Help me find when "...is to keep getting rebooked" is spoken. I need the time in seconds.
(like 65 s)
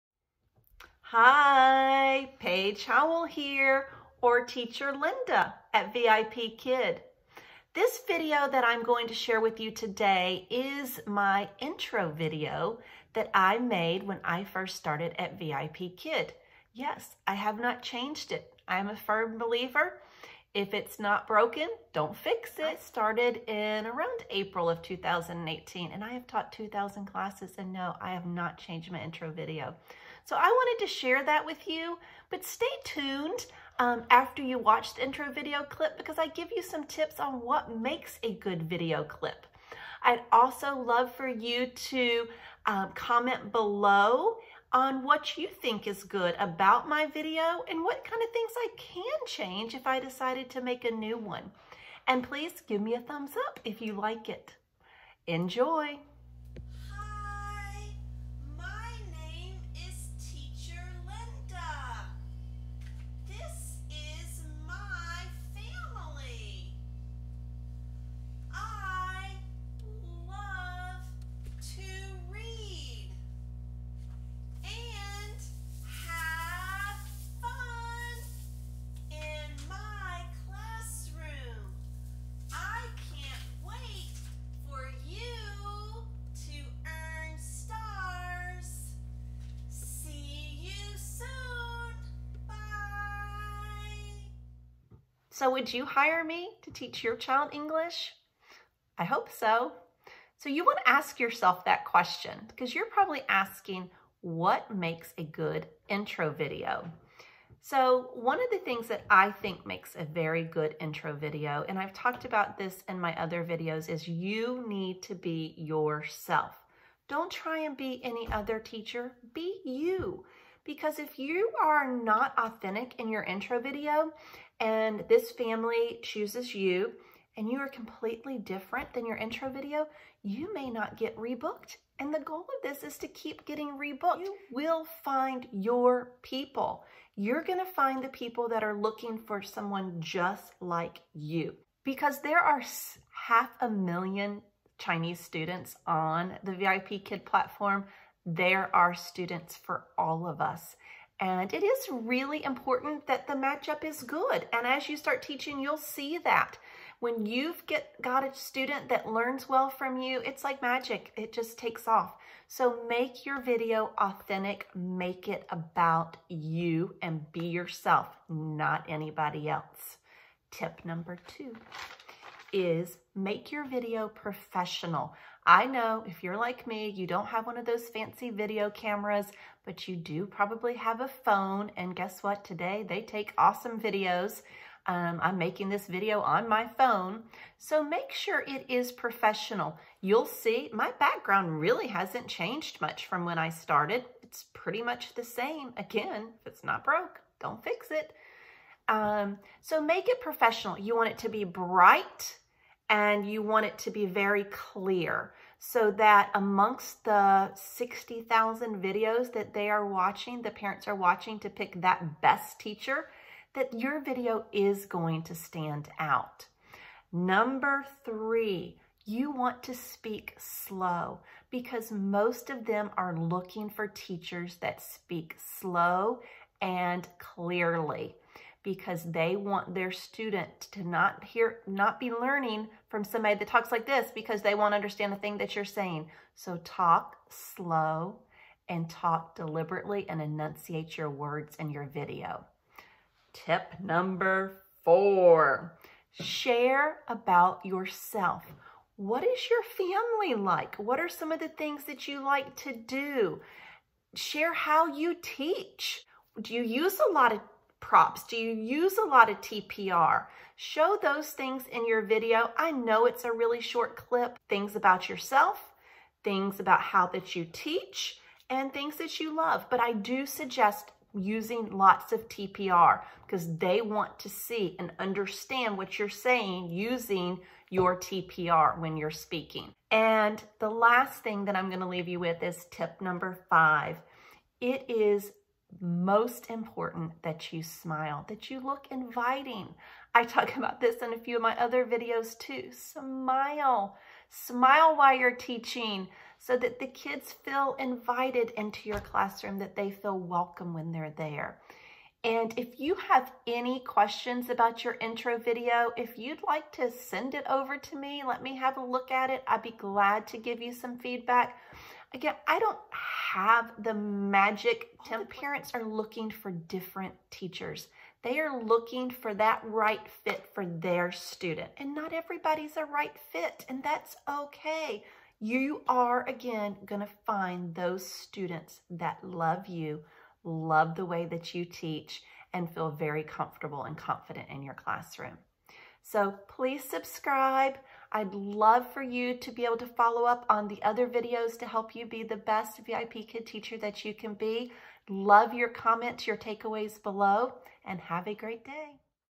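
132 s.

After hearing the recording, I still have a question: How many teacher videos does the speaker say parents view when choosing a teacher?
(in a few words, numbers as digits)
60,000.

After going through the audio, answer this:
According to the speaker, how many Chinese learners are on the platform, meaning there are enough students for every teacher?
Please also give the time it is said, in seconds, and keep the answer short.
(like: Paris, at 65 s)
half a million, at 143 s.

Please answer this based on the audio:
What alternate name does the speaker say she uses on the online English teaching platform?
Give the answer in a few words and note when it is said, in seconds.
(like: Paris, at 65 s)
Teacher Linda, at 4 s.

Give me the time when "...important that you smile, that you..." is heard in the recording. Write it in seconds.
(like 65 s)
286 s.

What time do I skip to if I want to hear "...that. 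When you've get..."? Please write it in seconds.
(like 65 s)
156 s.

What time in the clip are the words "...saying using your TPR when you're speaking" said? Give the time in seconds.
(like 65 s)
276 s.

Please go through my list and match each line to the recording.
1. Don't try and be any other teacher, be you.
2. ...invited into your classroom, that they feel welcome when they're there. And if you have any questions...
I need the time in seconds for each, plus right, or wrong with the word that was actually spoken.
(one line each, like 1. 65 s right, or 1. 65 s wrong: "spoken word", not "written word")
1. 117 s right
2. 297 s right.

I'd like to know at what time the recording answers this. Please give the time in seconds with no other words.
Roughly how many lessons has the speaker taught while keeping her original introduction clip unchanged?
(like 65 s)
26 s.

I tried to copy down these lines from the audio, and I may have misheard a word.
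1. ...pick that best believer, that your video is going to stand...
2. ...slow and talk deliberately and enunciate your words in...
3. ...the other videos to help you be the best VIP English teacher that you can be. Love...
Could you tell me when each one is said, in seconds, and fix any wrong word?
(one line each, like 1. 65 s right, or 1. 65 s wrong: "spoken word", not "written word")
1. 211 s wrong: "teacher", not "believer"
2. 237 s right
3. 340 s wrong: "Kid", not "English".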